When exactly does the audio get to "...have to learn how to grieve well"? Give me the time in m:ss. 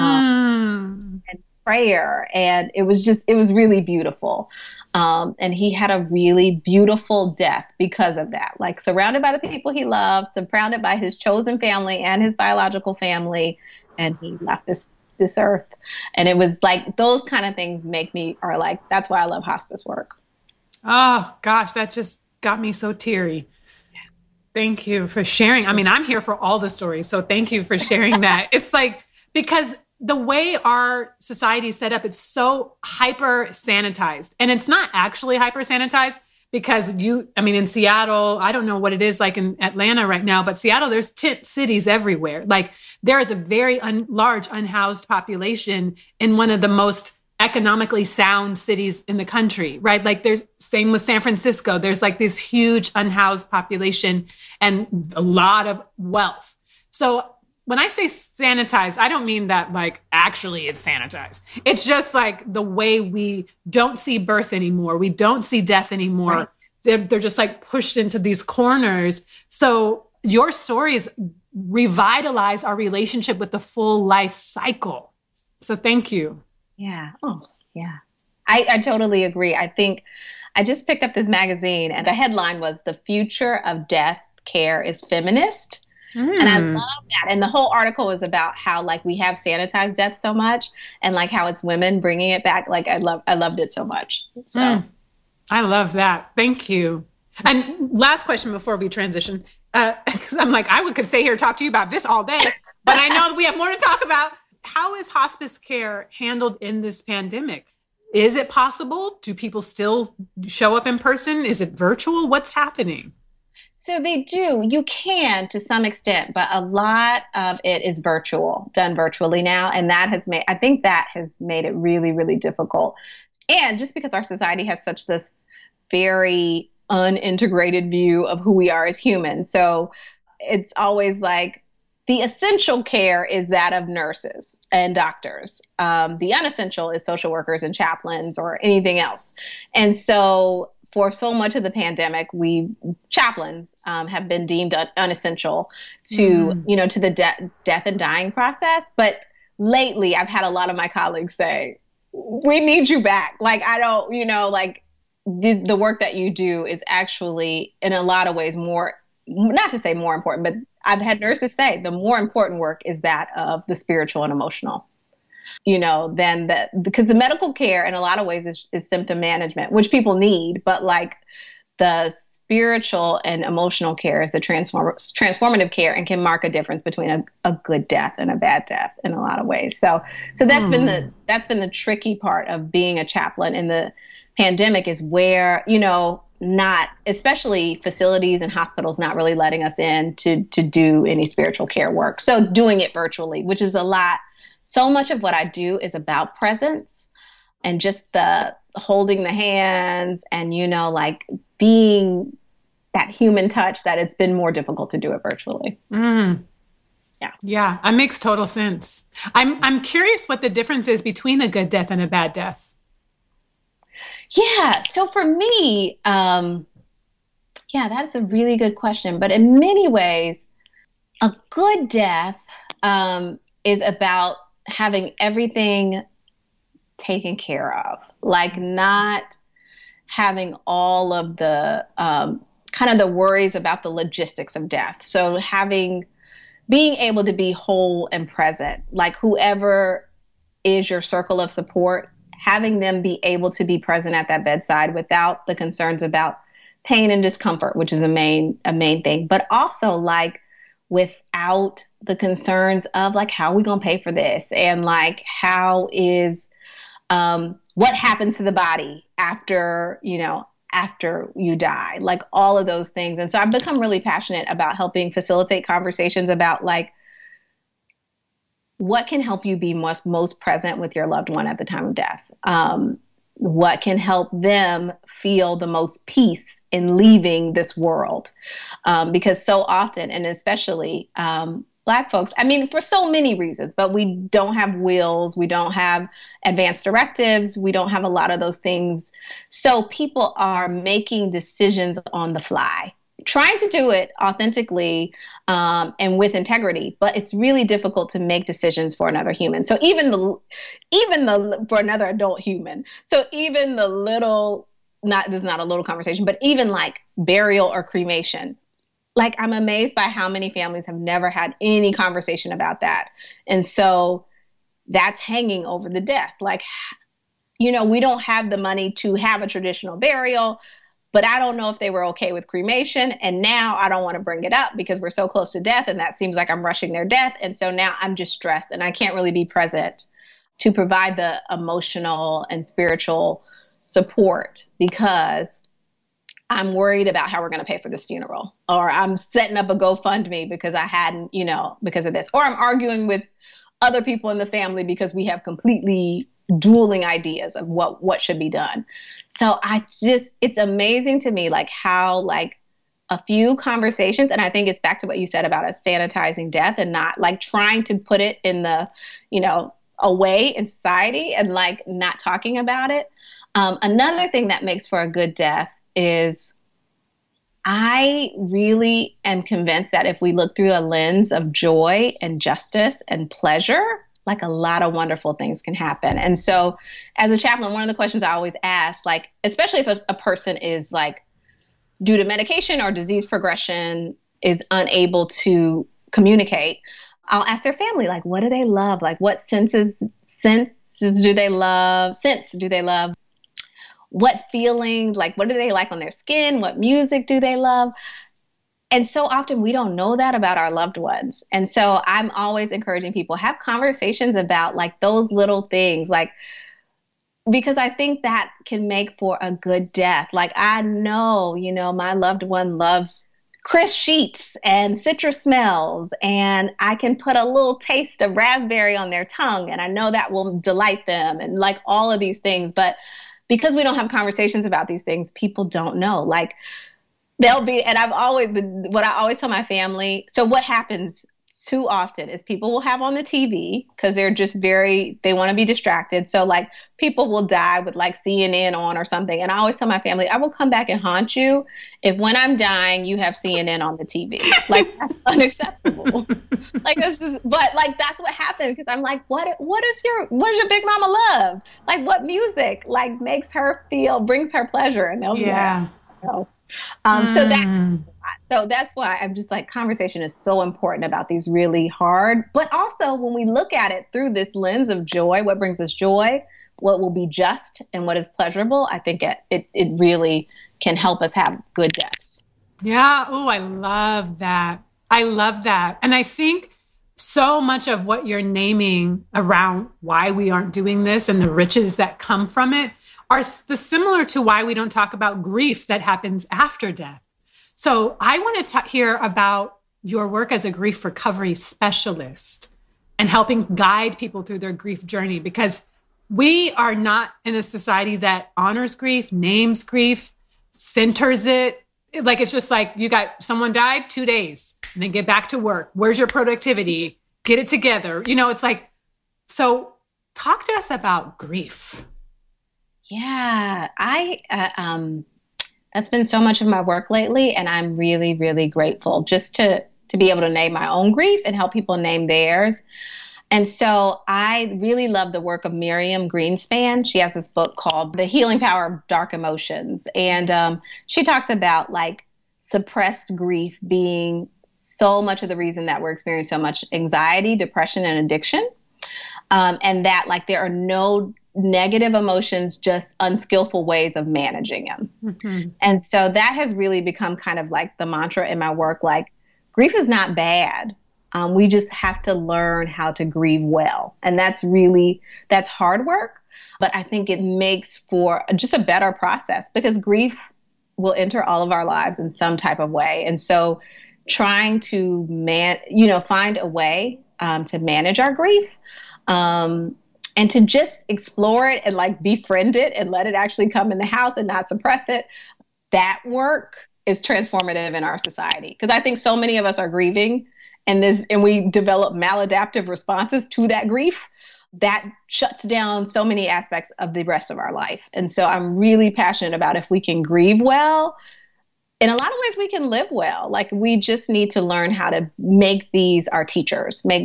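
9:11.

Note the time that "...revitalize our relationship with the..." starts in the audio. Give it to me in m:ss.
1:11.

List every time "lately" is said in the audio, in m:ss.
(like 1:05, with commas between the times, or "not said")
2:29, 8:37.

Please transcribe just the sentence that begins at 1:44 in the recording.
How is hospice care handled in this pandemic?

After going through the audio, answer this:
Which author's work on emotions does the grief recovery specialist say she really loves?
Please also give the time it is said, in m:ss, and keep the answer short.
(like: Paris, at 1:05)
Miriam Greenspan, at 8:45.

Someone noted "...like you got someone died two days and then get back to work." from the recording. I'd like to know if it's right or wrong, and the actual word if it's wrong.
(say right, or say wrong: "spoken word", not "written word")
right.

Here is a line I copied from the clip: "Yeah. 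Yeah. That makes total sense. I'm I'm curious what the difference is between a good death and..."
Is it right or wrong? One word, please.
right.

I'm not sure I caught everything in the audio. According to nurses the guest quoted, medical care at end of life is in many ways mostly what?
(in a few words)
symptom management.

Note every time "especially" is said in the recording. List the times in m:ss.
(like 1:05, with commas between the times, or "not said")
3:07, 4:40, 6:19.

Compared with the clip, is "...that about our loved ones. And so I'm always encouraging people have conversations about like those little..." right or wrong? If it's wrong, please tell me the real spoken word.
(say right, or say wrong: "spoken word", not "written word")
right.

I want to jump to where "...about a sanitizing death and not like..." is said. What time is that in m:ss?
5:55.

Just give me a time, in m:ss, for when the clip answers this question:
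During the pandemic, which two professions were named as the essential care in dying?
2:13.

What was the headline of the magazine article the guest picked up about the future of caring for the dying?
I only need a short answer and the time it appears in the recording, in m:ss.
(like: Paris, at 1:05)
The Future of Death Care is Feminist, at 1:22.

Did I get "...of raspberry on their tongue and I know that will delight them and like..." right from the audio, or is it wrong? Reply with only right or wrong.
right.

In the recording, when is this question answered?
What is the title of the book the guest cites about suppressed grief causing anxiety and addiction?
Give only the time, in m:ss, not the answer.
8:48.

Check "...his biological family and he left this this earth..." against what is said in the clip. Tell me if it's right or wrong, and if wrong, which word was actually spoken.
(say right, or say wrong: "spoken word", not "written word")
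right.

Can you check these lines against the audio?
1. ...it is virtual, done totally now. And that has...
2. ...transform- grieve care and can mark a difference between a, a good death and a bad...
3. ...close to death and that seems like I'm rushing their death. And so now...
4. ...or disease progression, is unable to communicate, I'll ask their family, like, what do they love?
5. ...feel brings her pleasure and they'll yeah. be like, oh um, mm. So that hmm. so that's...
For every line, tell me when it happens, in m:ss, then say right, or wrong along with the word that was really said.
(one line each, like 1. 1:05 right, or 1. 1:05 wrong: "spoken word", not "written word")
1. 1:57 wrong: "virtually", not "totally"
2. 2:54 wrong: "transformative", not "grieve"
3. 5:25 right
4. 6:22 right
5. 7:33 right.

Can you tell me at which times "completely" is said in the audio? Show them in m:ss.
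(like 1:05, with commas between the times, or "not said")
5:45.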